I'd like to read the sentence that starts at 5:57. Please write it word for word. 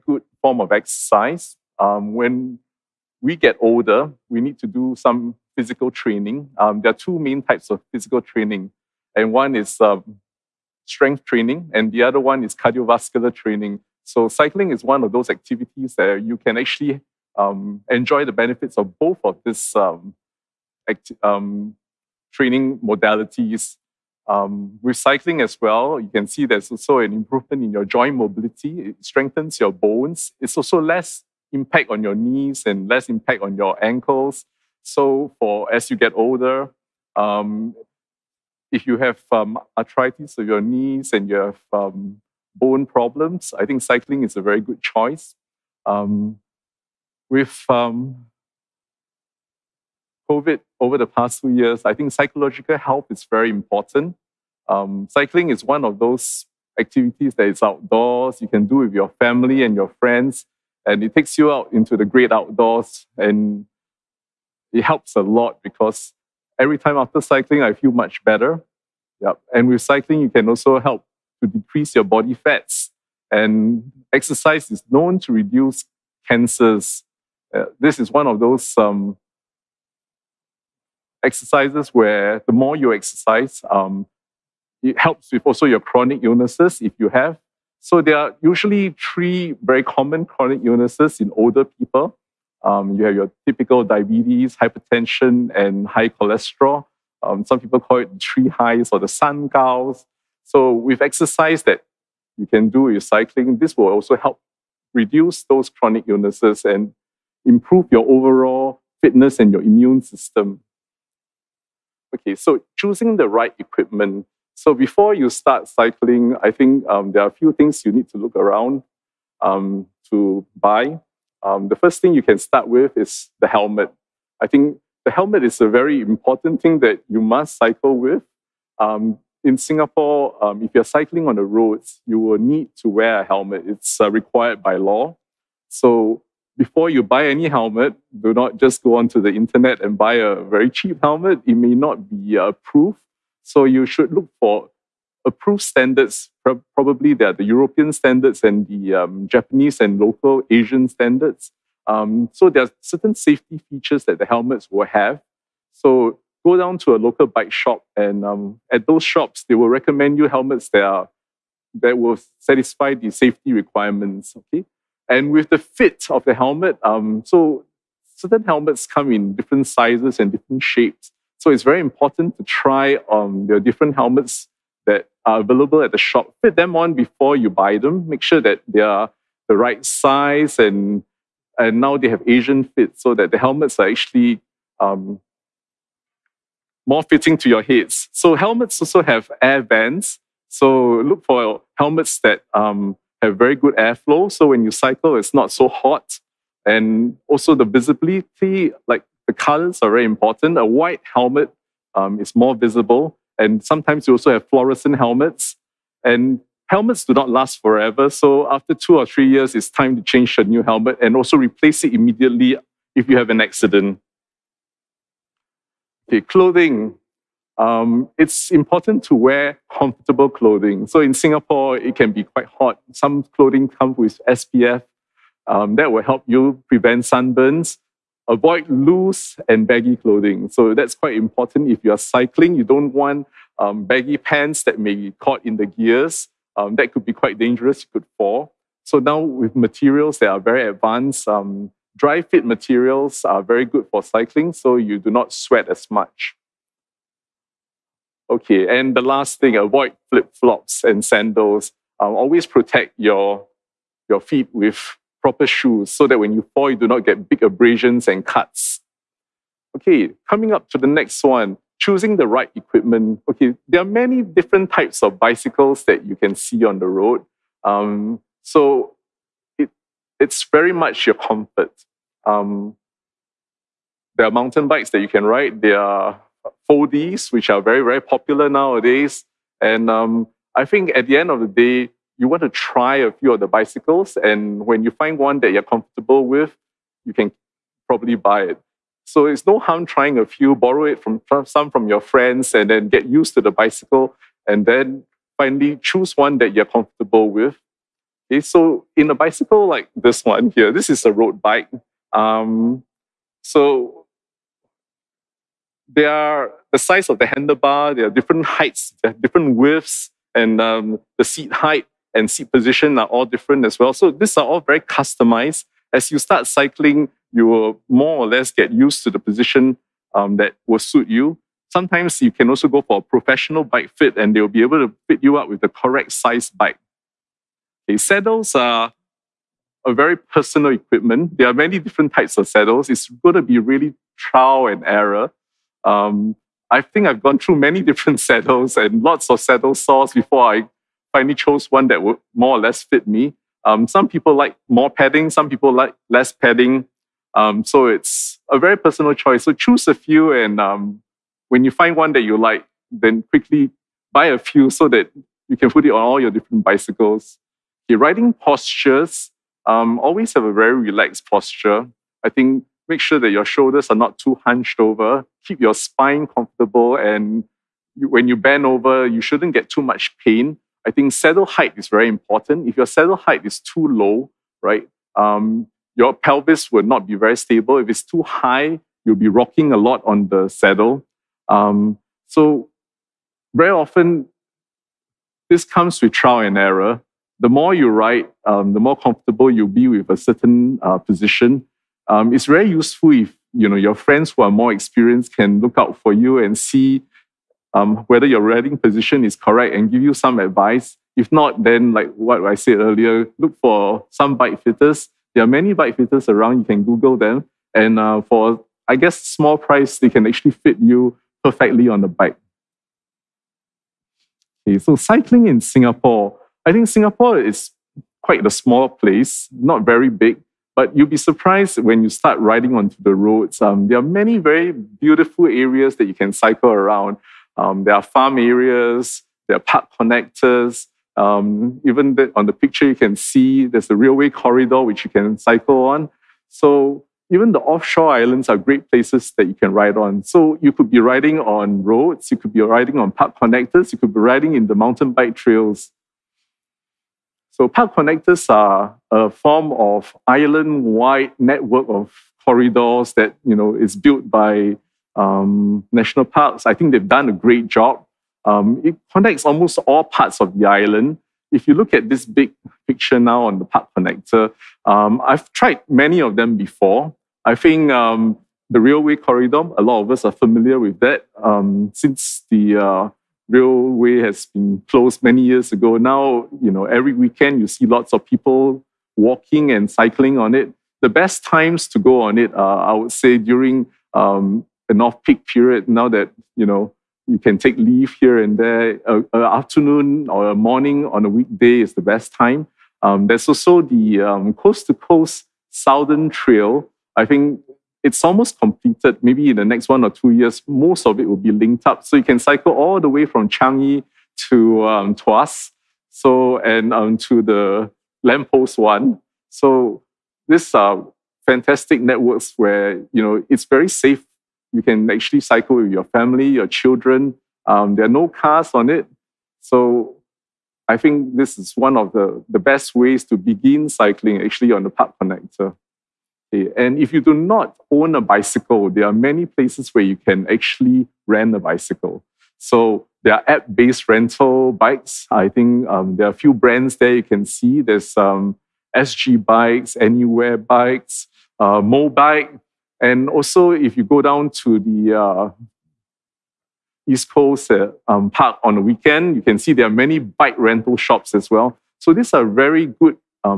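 Okay, riding postures um, always have a very relaxed posture.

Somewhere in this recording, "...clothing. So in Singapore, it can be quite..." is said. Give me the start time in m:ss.
3:40.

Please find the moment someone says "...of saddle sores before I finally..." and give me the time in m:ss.
5:39.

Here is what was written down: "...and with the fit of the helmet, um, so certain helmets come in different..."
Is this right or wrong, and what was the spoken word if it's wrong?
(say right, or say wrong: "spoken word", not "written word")
right.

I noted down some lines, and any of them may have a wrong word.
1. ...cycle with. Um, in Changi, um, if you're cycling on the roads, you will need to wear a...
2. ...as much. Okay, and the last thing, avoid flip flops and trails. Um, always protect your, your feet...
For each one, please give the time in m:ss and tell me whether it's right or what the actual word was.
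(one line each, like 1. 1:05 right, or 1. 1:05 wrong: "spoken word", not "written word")
1. 2:07 wrong: "Singapore", not "Changi"
2. 4:05 wrong: "sandals", not "trails".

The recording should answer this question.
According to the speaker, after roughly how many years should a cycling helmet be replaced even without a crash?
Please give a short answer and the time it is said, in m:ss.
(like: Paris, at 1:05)
2 or 3 years, at 3:28.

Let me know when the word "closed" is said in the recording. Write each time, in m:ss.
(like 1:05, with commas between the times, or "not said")
7:54.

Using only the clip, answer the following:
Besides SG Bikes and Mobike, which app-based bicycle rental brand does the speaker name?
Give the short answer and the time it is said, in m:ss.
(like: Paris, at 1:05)
Anywheel, at 8:59.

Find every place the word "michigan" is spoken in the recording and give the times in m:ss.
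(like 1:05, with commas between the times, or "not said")
not said.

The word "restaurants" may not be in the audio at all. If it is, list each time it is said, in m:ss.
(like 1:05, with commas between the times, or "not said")
not said.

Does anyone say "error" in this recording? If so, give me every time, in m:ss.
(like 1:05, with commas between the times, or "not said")
5:34, 6:26.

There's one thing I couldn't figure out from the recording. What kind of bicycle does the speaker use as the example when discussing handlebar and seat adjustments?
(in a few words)
Road bike.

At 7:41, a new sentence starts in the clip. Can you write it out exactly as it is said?
If you look at this big picture now on the park connector, um, I've tried many of them before.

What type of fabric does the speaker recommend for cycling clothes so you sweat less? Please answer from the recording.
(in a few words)
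Dry fit.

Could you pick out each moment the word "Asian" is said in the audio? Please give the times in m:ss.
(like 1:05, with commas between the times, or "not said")
2:30, 3:02.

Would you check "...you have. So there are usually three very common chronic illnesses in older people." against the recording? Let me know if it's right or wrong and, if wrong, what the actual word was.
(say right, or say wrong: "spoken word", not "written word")
right.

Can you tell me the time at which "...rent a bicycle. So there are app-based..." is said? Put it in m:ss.
8:51.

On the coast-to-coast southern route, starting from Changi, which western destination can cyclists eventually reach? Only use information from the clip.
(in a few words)
Tuas.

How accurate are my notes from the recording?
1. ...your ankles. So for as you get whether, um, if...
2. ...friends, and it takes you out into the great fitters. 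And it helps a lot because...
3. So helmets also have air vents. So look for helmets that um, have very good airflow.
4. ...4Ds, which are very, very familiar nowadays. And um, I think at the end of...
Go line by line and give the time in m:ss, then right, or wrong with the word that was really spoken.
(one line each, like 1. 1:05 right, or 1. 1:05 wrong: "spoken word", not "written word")
1. 0:33 wrong: "older", not "whether"
2. 0:59 wrong: "outdoors", not "fitters"
3. 3:08 right
4. 4:36 wrong: "popular", not "familiar".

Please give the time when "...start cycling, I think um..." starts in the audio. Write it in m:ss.
1:55.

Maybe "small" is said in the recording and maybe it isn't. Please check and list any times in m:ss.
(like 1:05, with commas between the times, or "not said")
6:49, 6:58.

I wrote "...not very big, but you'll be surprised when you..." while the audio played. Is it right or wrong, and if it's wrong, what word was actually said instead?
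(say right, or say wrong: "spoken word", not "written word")
right.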